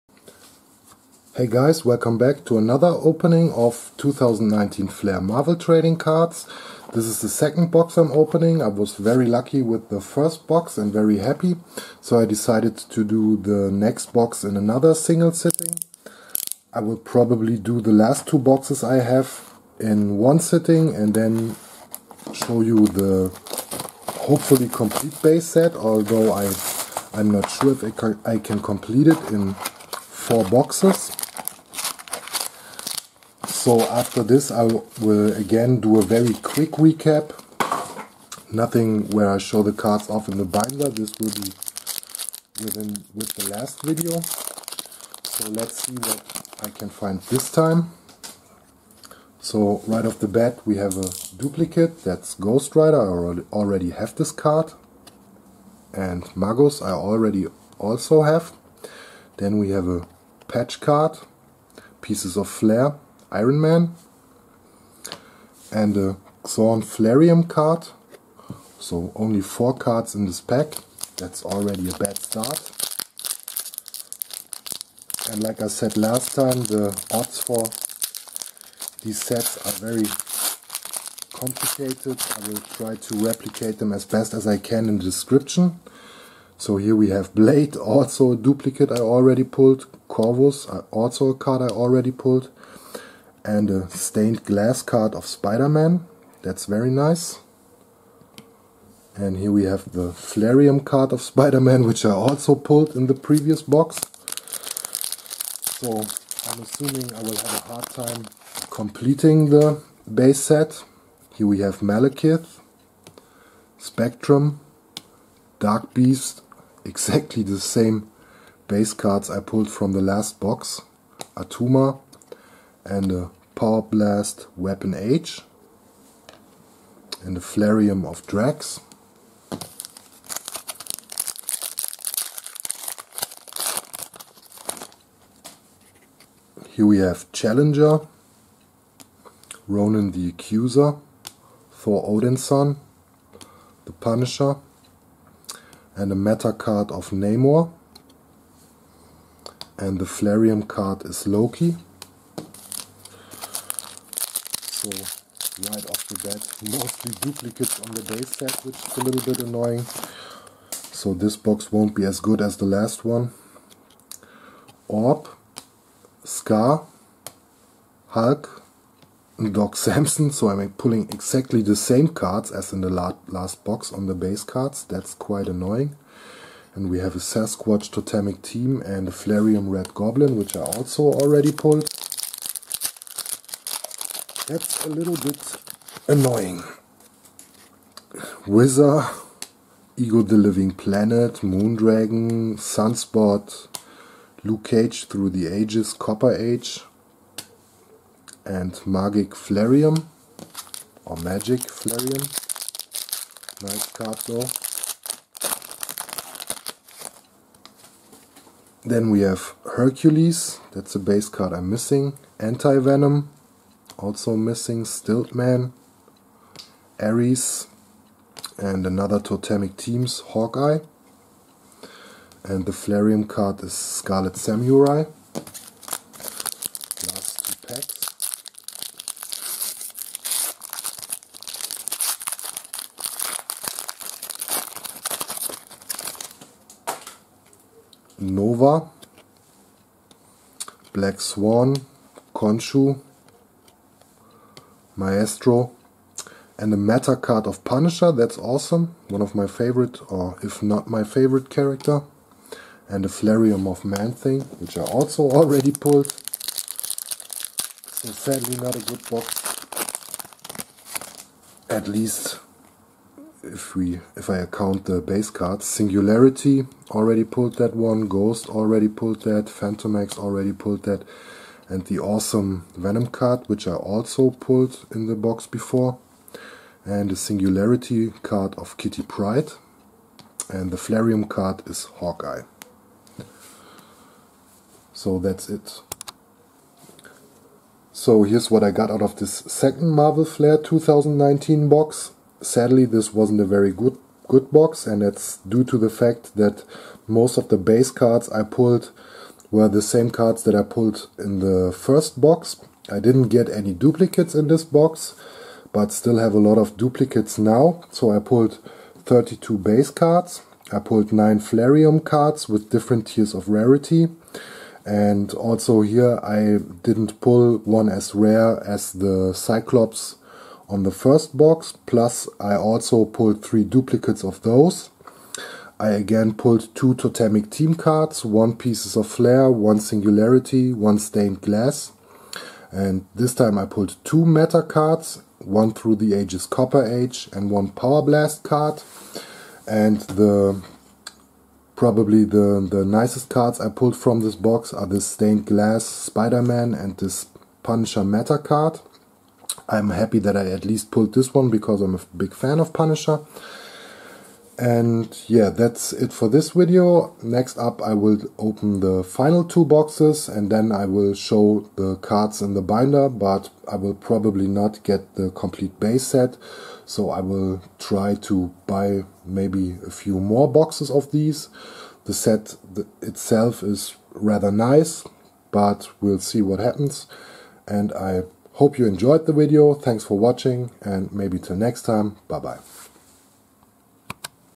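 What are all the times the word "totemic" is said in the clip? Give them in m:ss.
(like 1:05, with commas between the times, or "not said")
2:57, 3:39, 5:26.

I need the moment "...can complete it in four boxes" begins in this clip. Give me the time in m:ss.
0:28.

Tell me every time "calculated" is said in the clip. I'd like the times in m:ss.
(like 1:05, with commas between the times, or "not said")
not said.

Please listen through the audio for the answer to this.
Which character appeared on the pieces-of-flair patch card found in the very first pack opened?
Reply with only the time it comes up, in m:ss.
1:03.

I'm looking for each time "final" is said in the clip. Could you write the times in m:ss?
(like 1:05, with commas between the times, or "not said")
5:59.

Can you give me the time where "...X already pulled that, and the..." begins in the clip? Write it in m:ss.
4:29.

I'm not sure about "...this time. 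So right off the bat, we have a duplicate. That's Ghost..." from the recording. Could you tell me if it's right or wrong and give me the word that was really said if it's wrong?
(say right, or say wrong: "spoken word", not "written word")
right.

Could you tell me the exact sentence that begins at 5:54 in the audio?
And yeah, that's it for this video.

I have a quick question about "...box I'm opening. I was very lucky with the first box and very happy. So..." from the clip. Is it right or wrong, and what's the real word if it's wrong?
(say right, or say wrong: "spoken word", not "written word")
right.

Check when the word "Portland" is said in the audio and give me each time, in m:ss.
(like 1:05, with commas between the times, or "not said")
not said.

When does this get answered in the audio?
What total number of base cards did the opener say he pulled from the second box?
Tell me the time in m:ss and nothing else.
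5:09.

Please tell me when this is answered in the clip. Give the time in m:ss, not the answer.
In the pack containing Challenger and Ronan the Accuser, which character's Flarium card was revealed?
2:31.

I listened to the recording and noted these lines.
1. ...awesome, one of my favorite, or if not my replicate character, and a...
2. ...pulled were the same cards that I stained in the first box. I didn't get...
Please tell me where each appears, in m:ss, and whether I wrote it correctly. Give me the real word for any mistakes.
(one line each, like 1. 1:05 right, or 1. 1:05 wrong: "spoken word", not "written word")
1. 4:08 wrong: "favorite", not "replicate"
2. 4:58 wrong: "pulled", not "stained".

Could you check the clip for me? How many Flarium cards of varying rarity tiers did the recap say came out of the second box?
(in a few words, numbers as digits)
9.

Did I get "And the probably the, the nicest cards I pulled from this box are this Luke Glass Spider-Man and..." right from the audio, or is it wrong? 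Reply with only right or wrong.
wrong.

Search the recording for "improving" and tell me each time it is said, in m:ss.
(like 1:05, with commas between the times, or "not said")
not said.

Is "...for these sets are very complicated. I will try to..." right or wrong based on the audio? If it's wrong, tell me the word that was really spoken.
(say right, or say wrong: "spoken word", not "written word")
right.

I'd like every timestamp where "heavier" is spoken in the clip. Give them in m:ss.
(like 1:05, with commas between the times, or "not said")
not said.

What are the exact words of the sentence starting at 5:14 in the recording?
And also here I didn't pull one as rare as the Cyclops on the first box.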